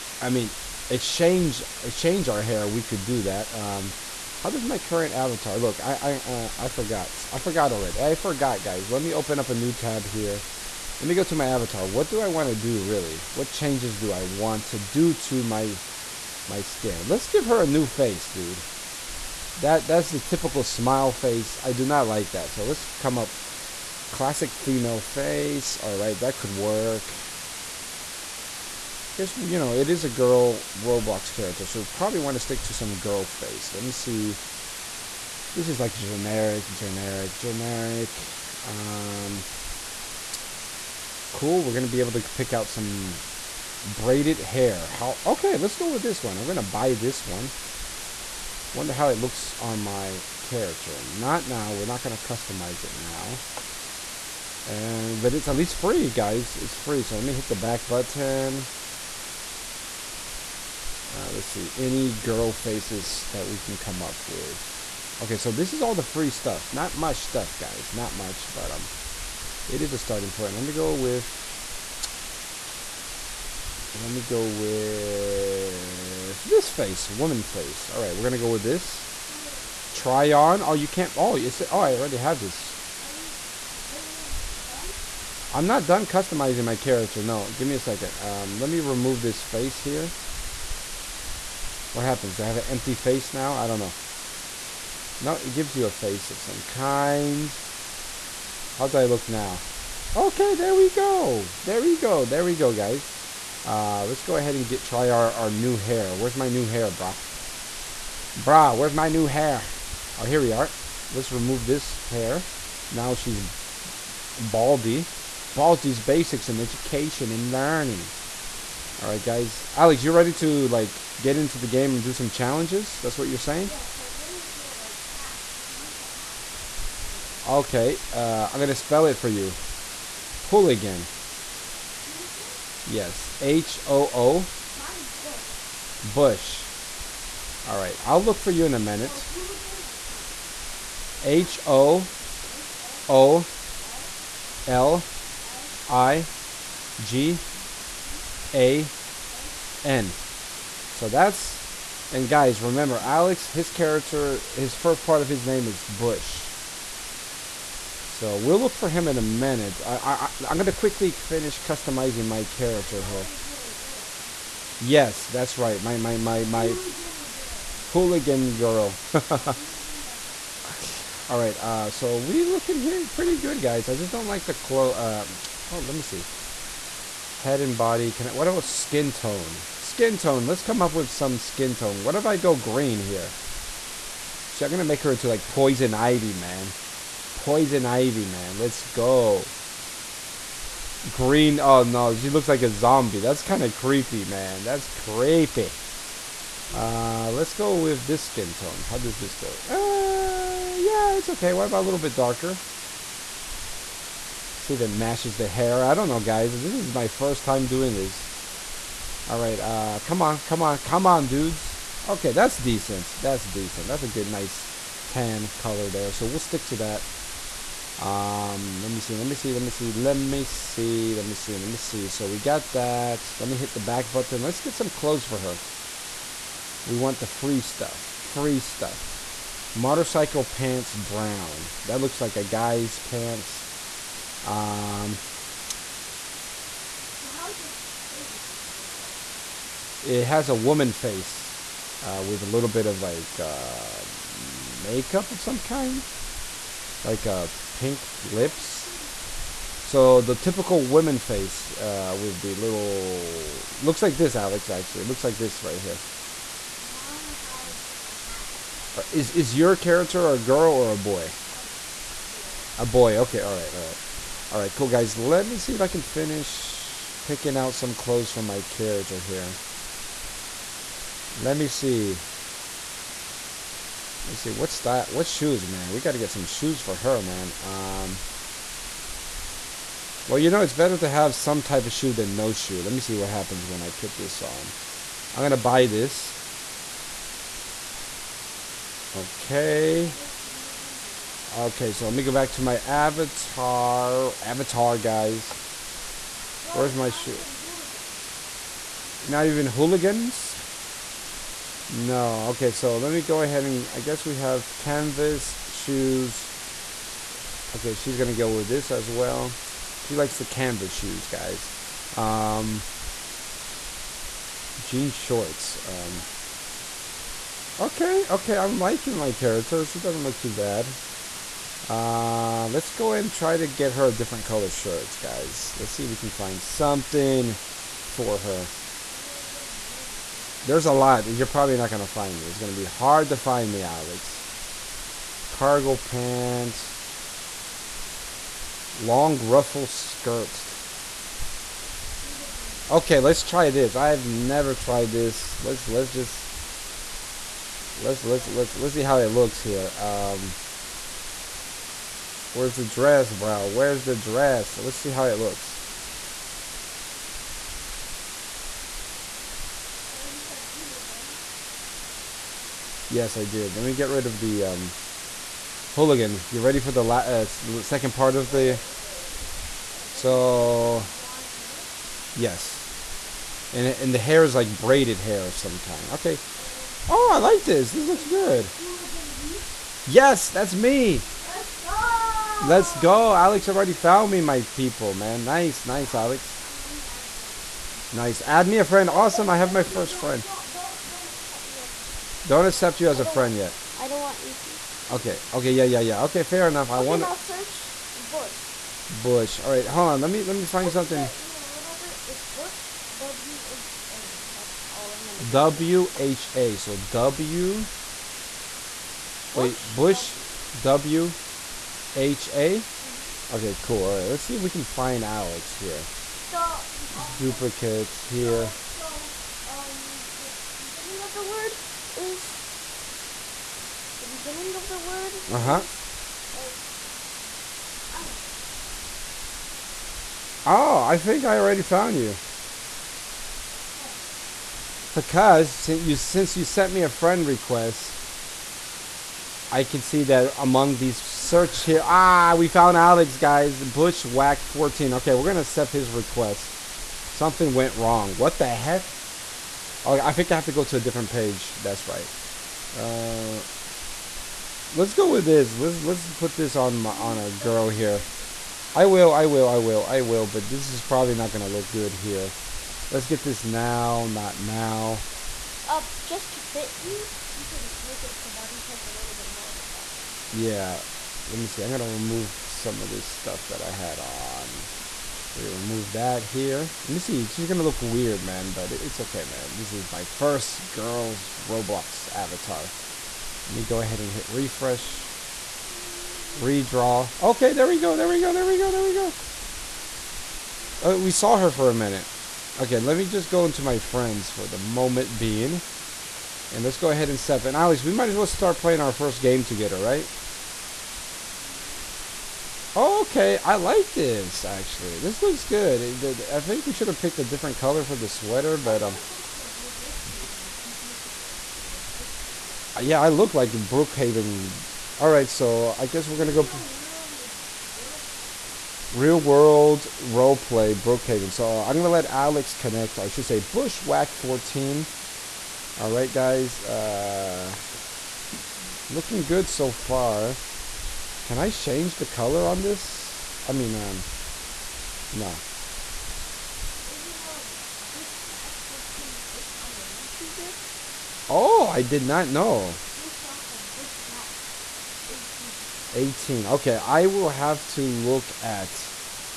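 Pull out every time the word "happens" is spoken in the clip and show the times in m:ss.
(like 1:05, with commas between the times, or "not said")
1:32, 4:43.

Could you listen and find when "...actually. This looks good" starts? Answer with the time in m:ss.
8:24.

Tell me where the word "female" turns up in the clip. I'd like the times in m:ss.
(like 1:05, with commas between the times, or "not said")
0:24.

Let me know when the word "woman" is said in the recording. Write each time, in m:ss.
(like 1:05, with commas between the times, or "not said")
1:17, 4:00.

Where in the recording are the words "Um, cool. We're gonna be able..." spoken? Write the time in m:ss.
0:38.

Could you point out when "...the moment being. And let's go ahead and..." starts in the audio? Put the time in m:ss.
8:14.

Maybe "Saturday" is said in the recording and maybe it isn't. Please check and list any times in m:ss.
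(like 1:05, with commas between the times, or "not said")
not said.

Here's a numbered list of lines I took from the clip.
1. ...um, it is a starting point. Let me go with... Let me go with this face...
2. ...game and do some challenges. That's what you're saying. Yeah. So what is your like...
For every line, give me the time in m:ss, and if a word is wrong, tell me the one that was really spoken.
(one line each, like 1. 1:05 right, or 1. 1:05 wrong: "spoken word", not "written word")
1. 1:08 right
2. 2:01 right.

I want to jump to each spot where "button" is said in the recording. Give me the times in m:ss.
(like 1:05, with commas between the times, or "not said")
0:57, 3:44.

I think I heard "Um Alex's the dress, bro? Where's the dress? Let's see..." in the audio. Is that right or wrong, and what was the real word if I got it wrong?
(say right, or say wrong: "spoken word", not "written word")
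wrong: "Where", not "Alex".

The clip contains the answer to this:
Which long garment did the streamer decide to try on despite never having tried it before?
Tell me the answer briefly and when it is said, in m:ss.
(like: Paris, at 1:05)
Long ruffle skirts, at 5:38.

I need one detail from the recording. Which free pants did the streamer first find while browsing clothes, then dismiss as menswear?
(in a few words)
Motorcycle pants brown.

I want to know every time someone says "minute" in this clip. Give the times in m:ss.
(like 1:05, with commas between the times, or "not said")
2:18, 2:39, 8:11.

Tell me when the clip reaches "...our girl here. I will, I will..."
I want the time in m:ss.
7:37.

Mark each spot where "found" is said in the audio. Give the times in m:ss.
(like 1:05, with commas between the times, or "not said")
6:23, 7:11, 7:22.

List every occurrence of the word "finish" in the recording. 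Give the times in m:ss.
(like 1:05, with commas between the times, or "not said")
2:41, 4:26.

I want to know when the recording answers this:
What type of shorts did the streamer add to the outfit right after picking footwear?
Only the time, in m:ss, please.
5:14.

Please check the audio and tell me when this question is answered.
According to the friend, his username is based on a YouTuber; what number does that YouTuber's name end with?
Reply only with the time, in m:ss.
9:03.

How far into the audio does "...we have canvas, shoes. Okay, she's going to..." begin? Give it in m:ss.
5:04.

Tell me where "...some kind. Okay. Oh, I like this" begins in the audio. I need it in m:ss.
6:15.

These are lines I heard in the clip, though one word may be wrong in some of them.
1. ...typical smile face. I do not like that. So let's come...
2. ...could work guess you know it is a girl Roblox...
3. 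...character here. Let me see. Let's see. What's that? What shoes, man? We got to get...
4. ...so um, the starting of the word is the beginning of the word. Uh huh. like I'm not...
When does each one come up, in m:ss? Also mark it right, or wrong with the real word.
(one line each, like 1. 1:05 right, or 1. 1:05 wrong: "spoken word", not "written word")
1. 0:20 right
2. 0:26 right
3. 4:28 right
4. 6:59 wrong: "beginning", not "starting".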